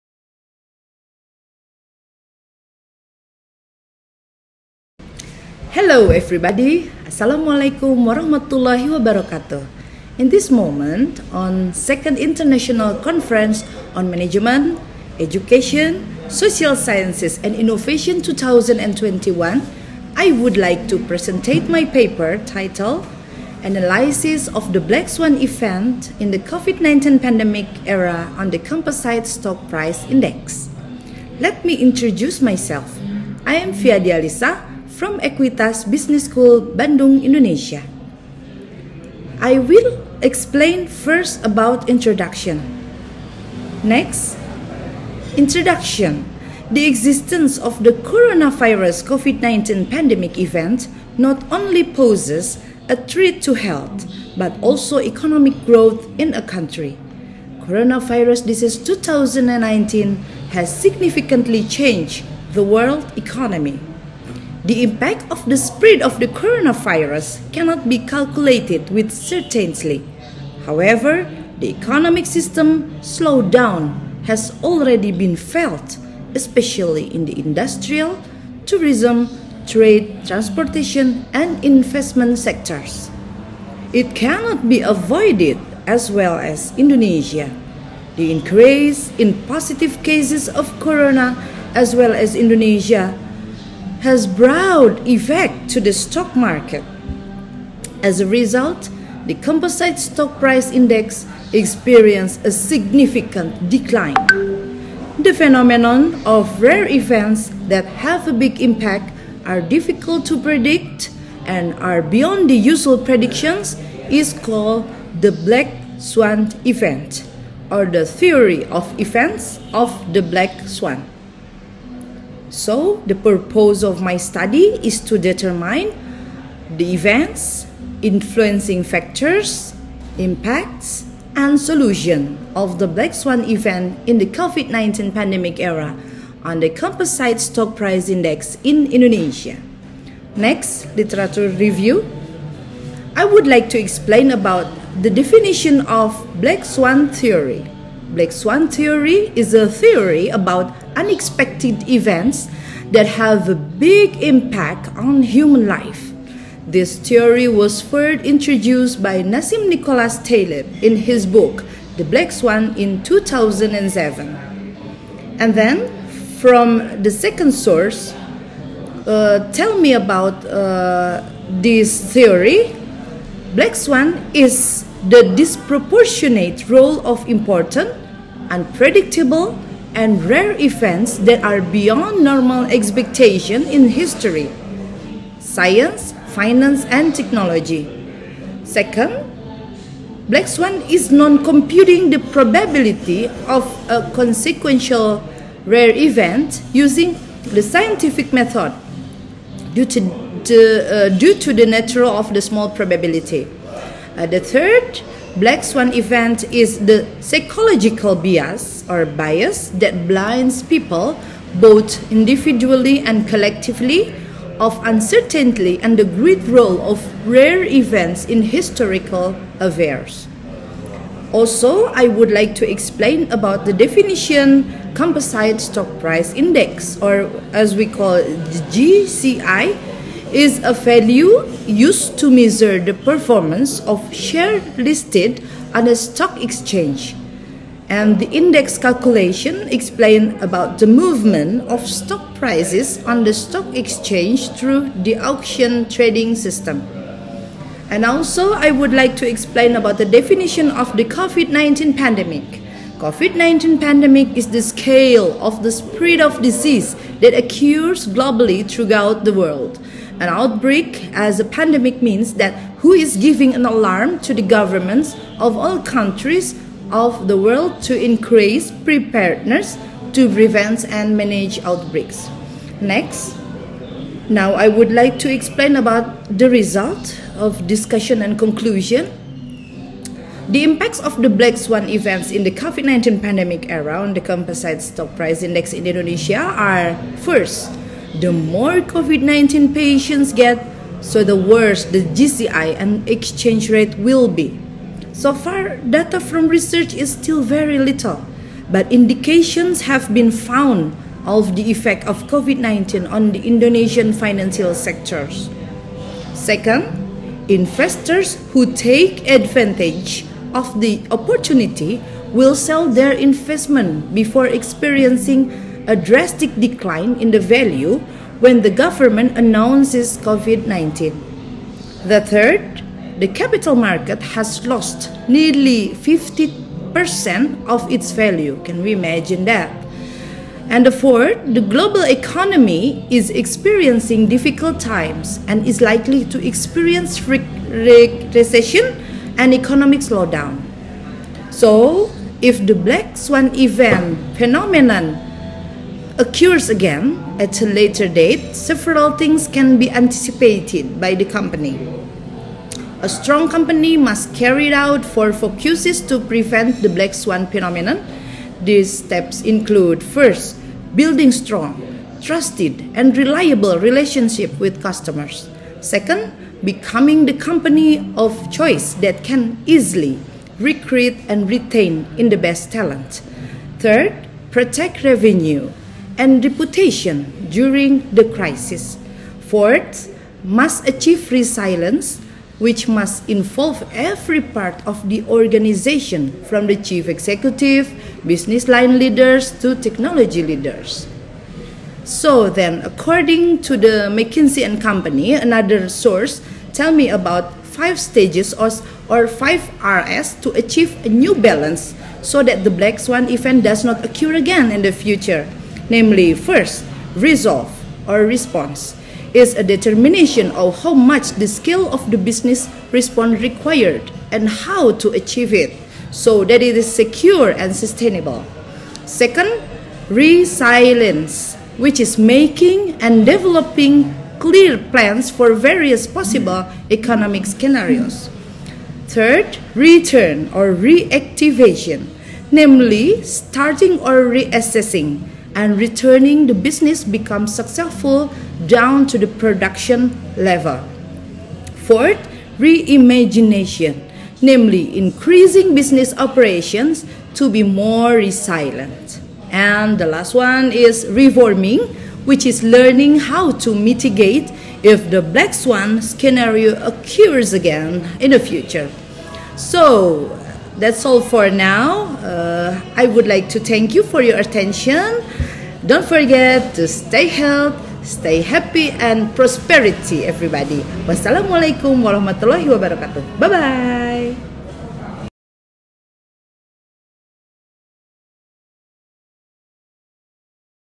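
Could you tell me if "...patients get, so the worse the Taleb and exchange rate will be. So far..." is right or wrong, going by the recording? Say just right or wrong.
wrong.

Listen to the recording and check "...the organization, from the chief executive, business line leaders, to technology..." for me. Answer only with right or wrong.
right.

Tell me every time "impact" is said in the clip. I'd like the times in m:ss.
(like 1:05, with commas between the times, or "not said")
1:04, 1:48, 2:10, 2:34, 4:40.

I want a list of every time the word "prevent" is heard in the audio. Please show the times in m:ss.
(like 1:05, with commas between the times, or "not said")
4:30, 5:56.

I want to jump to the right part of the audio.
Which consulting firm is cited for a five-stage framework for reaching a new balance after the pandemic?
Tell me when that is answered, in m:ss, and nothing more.
6:34.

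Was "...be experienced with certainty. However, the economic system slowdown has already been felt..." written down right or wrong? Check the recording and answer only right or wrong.
wrong.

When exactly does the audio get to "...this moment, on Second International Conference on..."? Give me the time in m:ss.
0:10.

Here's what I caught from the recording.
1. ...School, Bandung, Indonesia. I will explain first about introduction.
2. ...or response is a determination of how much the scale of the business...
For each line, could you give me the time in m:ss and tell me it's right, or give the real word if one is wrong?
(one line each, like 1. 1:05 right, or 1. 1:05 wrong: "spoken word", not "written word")
1. 0:36 right
2. 6:48 right.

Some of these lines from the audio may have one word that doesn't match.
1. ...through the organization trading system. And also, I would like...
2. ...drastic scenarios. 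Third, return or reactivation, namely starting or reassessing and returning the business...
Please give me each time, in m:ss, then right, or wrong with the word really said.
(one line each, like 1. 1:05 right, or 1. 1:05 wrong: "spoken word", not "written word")
1. 4:04 wrong: "auction", not "organization"
2. 7:06 wrong: "economic", not "drastic".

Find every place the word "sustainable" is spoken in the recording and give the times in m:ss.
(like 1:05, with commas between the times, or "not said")
6:57.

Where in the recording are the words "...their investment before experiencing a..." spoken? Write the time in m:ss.
5:12.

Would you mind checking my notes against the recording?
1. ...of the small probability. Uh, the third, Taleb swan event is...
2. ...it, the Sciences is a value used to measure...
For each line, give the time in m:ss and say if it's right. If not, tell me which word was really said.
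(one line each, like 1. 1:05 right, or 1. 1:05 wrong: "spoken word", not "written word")
1. 3:22 wrong: "Black", not "Taleb"
2. 3:48 wrong: "JCI", not "Sciences".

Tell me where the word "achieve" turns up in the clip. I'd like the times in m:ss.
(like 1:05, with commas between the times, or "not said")
6:20, 6:40, 6:55.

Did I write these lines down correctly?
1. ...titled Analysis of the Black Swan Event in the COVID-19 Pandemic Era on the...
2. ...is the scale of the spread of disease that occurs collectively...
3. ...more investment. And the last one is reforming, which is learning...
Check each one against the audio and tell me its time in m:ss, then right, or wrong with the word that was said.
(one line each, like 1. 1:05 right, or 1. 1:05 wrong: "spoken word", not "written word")
1. 0:22 right
2. 4:14 wrong: "globally", not "collectively"
3. 7:27 wrong: "resilient", not "investment".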